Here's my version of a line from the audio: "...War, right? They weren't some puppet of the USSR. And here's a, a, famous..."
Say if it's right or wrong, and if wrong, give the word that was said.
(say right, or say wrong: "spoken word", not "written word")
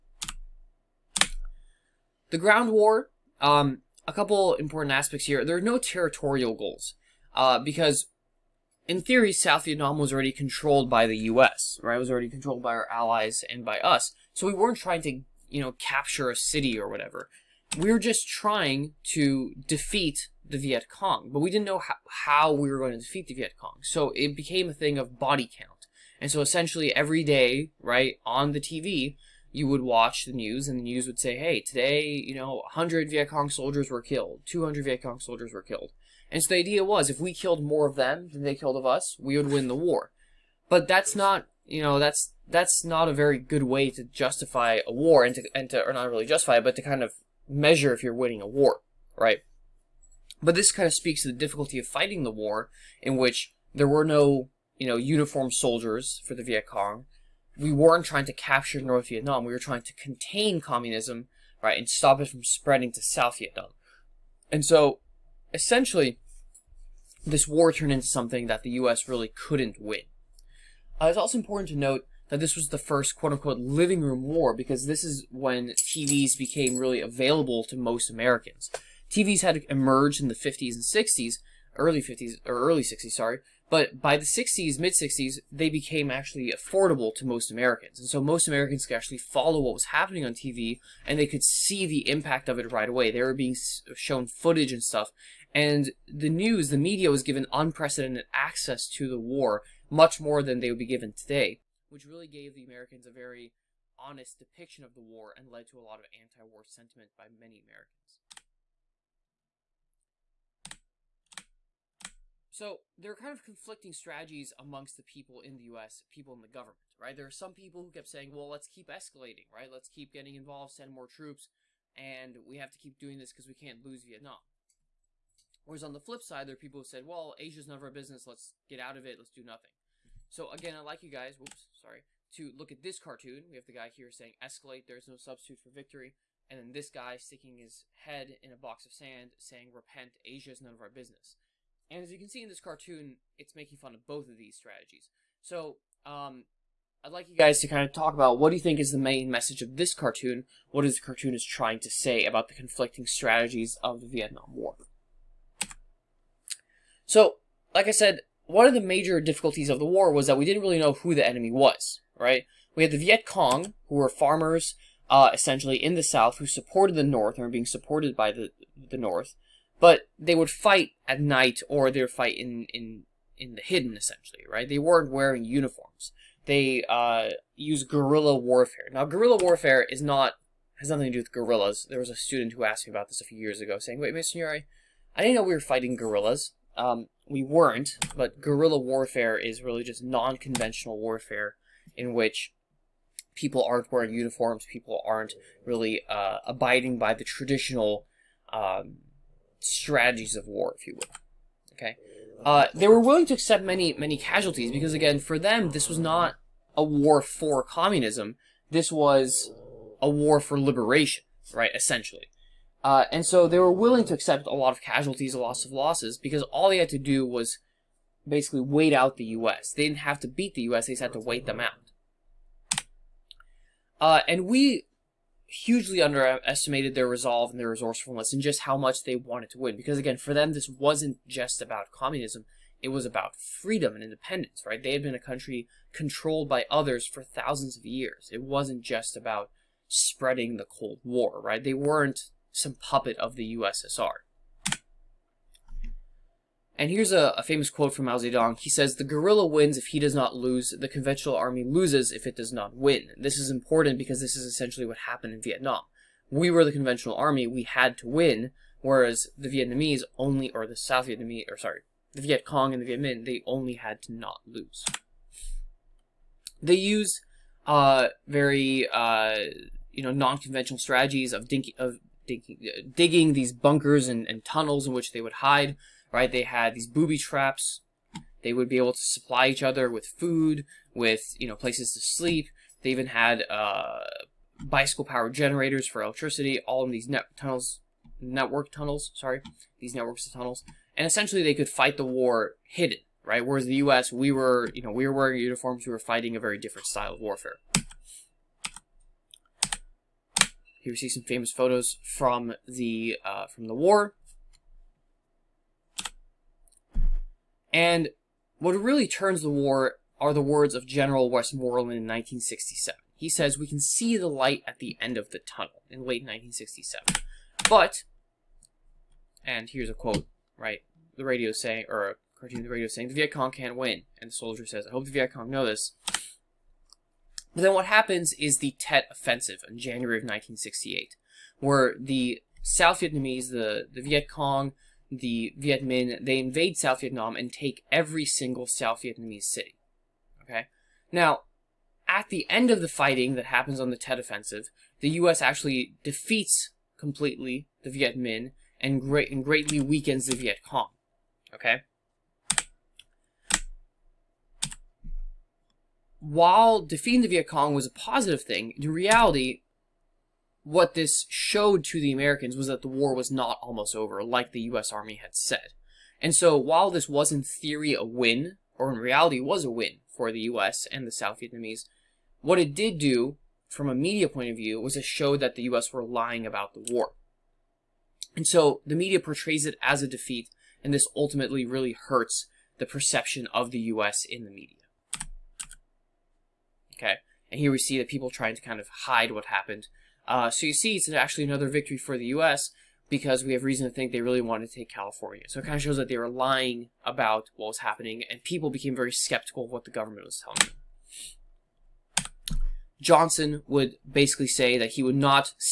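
right.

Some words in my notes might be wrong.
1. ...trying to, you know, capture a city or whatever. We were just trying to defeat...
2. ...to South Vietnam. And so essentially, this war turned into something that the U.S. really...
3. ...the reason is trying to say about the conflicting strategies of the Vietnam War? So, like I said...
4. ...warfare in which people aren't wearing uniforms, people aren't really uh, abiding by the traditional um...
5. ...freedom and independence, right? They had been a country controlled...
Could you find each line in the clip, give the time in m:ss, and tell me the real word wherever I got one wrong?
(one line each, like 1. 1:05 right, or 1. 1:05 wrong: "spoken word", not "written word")
1. 0:14 right
2. 1:02 right
3. 2:30 wrong: "cartoon", not "reason"
4. 3:10 right
5. 3:53 right.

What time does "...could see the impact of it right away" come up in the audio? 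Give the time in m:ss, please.
1:31.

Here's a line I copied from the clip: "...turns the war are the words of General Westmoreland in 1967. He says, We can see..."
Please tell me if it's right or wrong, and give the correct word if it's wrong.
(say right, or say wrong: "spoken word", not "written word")
right.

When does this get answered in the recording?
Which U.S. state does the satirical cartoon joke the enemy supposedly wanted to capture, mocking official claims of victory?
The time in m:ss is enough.
6:34.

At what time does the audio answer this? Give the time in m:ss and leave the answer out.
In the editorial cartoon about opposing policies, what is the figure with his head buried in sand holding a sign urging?
2:19.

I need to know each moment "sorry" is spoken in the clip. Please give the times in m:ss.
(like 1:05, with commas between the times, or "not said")
1:23, 2:11, 4:21, 4:49.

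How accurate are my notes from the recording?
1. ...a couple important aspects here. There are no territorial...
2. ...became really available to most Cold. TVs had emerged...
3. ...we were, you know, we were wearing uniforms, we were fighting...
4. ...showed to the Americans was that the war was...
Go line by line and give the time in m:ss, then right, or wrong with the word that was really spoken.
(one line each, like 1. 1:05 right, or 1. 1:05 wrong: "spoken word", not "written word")
1. 0:04 right
2. 1:16 wrong: "Americans", not "Cold"
3. 4:54 right
4. 6:01 right.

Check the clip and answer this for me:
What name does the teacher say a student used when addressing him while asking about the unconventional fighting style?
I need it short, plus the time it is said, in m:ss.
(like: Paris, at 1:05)
Mr. Signore, at 3:04.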